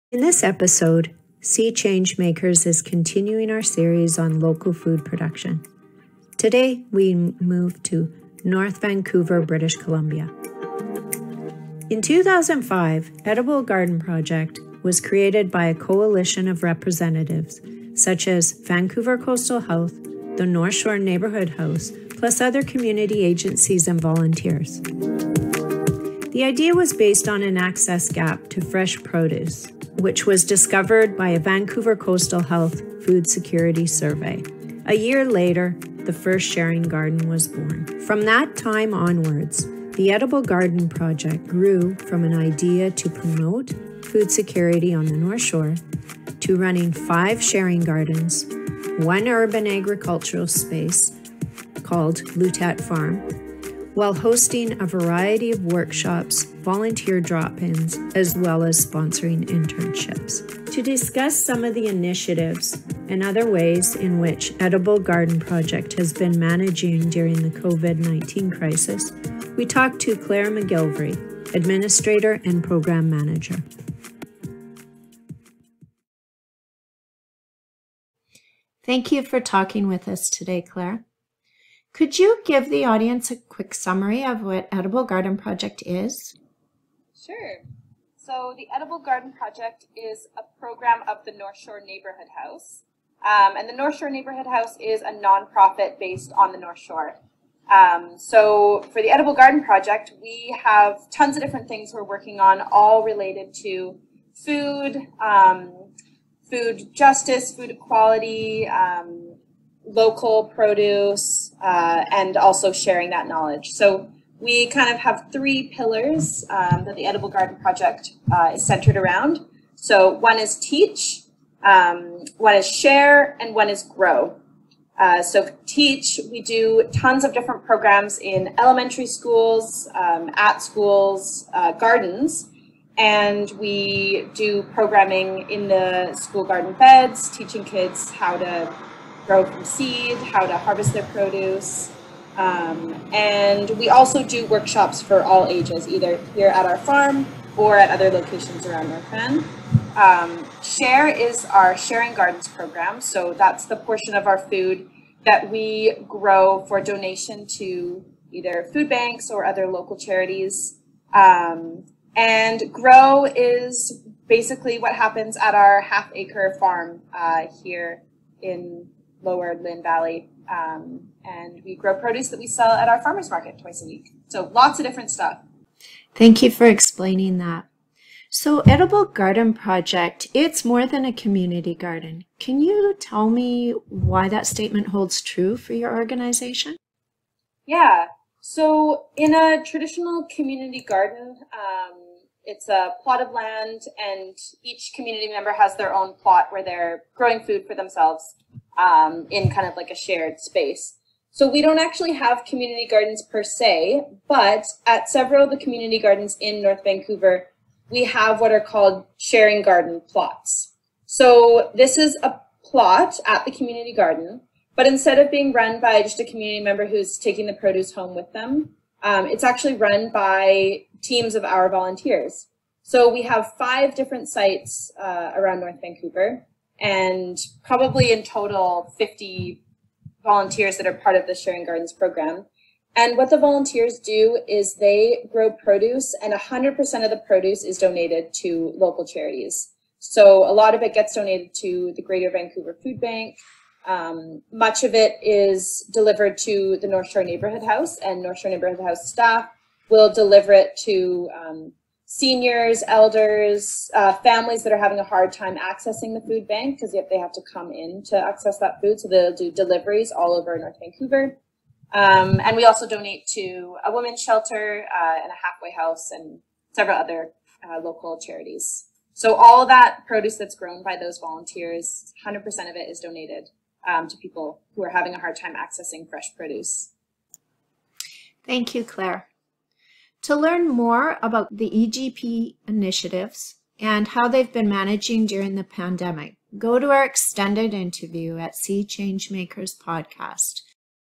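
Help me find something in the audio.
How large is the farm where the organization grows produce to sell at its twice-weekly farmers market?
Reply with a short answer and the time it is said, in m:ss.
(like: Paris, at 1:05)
half acre, at 2:45.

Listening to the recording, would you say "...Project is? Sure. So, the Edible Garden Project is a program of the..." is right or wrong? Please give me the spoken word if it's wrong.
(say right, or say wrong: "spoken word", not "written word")
right.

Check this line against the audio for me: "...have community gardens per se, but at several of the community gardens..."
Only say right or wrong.
right.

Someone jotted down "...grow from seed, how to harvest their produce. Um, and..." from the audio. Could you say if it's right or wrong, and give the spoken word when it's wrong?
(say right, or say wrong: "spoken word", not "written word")
right.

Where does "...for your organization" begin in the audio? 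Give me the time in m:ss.
3:05.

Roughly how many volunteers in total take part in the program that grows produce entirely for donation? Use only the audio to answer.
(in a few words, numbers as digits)
50.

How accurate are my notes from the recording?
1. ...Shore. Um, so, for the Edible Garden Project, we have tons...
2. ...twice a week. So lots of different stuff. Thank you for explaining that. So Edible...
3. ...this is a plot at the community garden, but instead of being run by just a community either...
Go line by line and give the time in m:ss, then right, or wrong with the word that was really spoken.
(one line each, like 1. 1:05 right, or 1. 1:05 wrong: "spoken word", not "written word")
1. 1:36 right
2. 2:53 right
3. 3:31 wrong: "member", not "either".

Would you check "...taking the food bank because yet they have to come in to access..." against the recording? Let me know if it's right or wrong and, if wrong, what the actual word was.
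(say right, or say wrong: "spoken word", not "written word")
wrong: "accessing", not "taking".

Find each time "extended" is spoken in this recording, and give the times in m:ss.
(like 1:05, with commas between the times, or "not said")
4:47.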